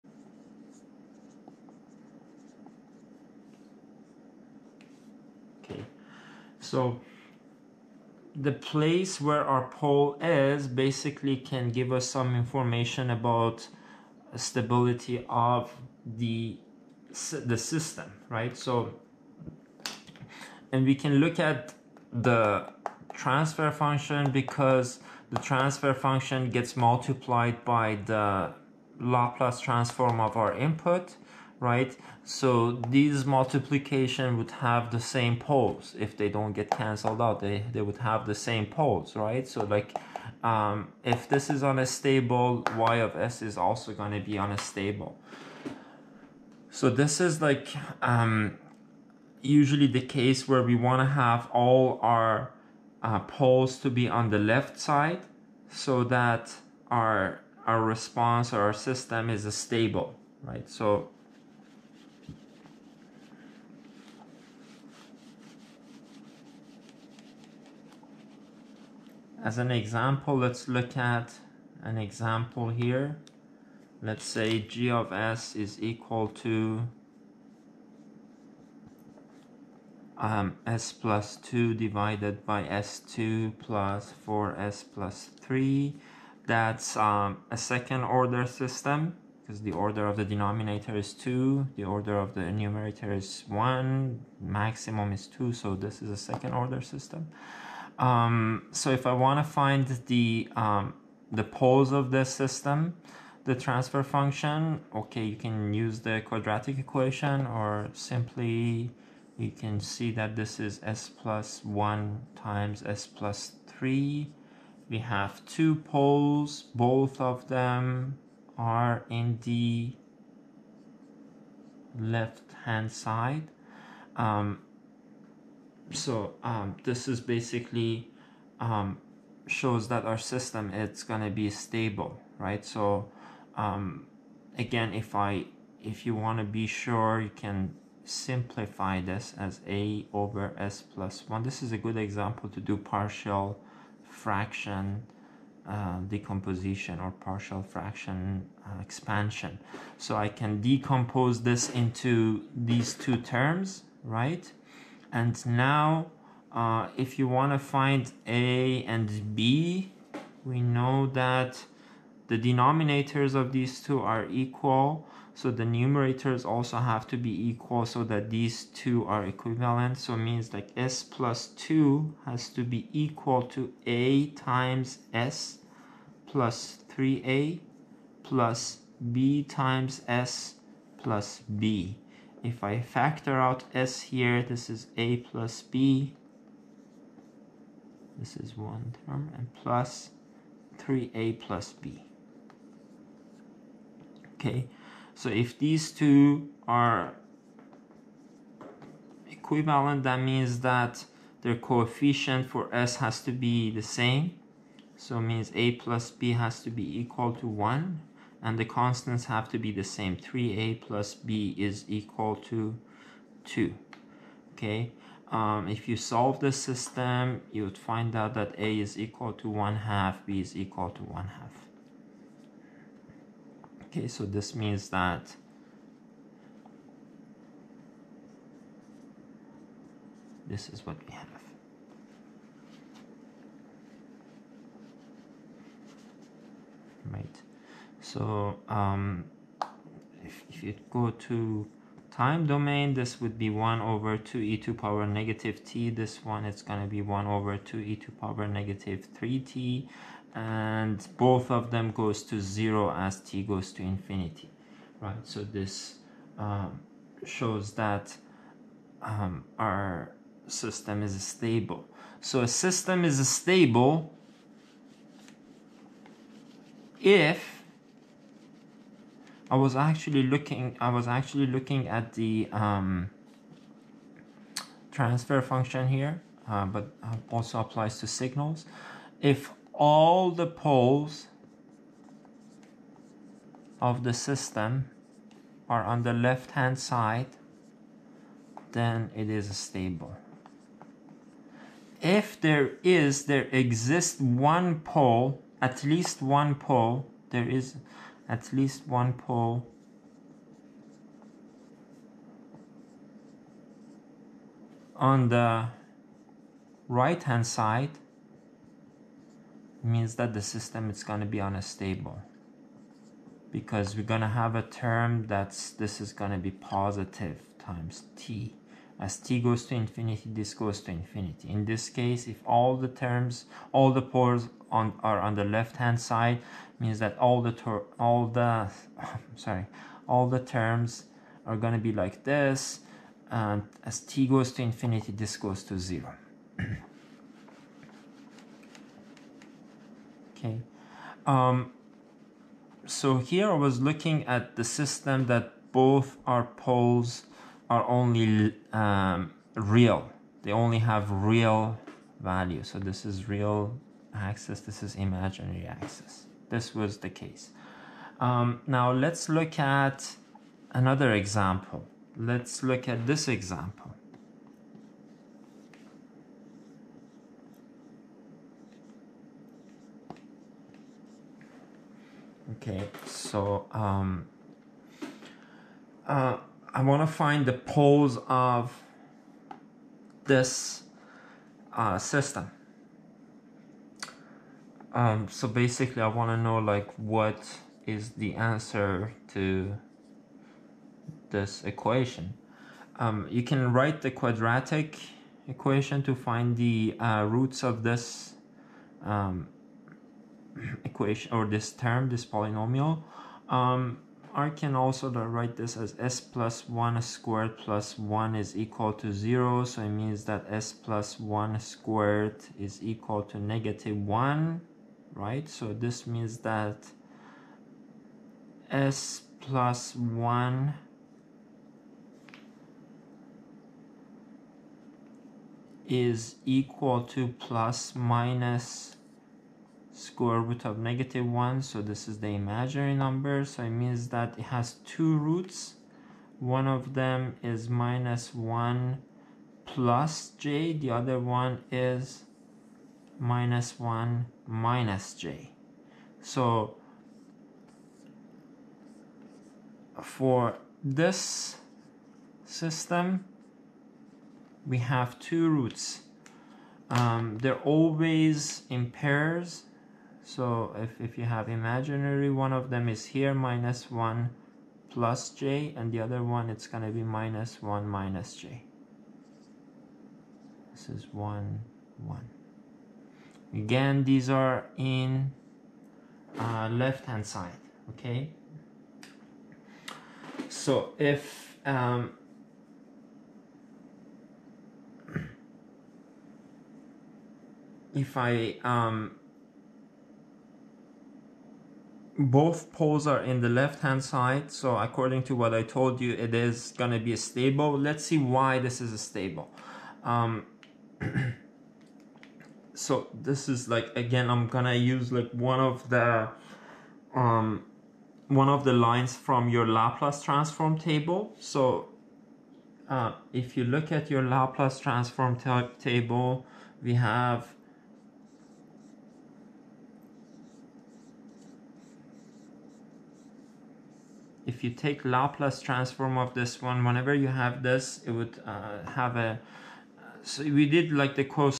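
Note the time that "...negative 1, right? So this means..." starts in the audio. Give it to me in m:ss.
6:53.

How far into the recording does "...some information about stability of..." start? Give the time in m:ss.
0:12.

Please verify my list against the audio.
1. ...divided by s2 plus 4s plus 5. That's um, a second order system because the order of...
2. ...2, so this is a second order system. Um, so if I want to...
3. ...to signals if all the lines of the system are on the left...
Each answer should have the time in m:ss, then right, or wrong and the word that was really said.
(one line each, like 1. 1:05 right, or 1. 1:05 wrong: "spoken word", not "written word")
1. 1:21 wrong: "3", not "5"
2. 1:35 right
3. 4:37 wrong: "poles", not "lines".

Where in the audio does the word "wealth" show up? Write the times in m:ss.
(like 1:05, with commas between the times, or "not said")
not said.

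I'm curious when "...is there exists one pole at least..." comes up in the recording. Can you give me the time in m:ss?
4:52.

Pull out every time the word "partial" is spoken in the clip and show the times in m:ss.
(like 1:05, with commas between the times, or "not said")
2:22, 2:27.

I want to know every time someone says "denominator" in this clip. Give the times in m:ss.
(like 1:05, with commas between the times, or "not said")
1:30, 2:42.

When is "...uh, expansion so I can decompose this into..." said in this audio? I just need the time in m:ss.
2:28.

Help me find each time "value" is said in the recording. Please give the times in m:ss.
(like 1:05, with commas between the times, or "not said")
5:52.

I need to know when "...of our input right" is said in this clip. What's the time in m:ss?
0:30.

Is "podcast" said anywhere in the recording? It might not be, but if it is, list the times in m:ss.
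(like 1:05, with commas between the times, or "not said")
not said.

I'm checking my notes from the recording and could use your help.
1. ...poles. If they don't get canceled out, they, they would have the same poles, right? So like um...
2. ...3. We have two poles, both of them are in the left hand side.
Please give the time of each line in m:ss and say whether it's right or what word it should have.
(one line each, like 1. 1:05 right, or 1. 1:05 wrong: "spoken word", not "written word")
1. 0:35 right
2. 1:53 right.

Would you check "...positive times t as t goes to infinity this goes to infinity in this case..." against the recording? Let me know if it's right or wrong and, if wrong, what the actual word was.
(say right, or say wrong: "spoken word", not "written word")
right.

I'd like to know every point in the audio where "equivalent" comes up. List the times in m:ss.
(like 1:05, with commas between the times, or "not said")
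2:49, 3:19.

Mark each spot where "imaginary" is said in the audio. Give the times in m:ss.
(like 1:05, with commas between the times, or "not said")
5:54, 7:12, 7:41.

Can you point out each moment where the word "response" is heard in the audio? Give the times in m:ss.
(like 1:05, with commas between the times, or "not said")
0:57.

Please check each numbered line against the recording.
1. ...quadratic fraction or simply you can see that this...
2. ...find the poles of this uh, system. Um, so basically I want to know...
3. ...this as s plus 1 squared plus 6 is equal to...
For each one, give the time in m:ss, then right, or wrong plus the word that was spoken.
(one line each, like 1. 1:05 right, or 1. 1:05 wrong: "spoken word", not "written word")
1. 1:46 wrong: "equation", not "fraction"
2. 6:17 right
3. 6:45 wrong: "1", not "6".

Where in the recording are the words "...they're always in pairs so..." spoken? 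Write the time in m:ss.
7:37.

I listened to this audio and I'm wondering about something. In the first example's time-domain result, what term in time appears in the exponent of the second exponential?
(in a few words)
-3t.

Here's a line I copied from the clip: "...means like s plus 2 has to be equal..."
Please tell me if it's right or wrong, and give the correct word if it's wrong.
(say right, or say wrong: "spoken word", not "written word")
right.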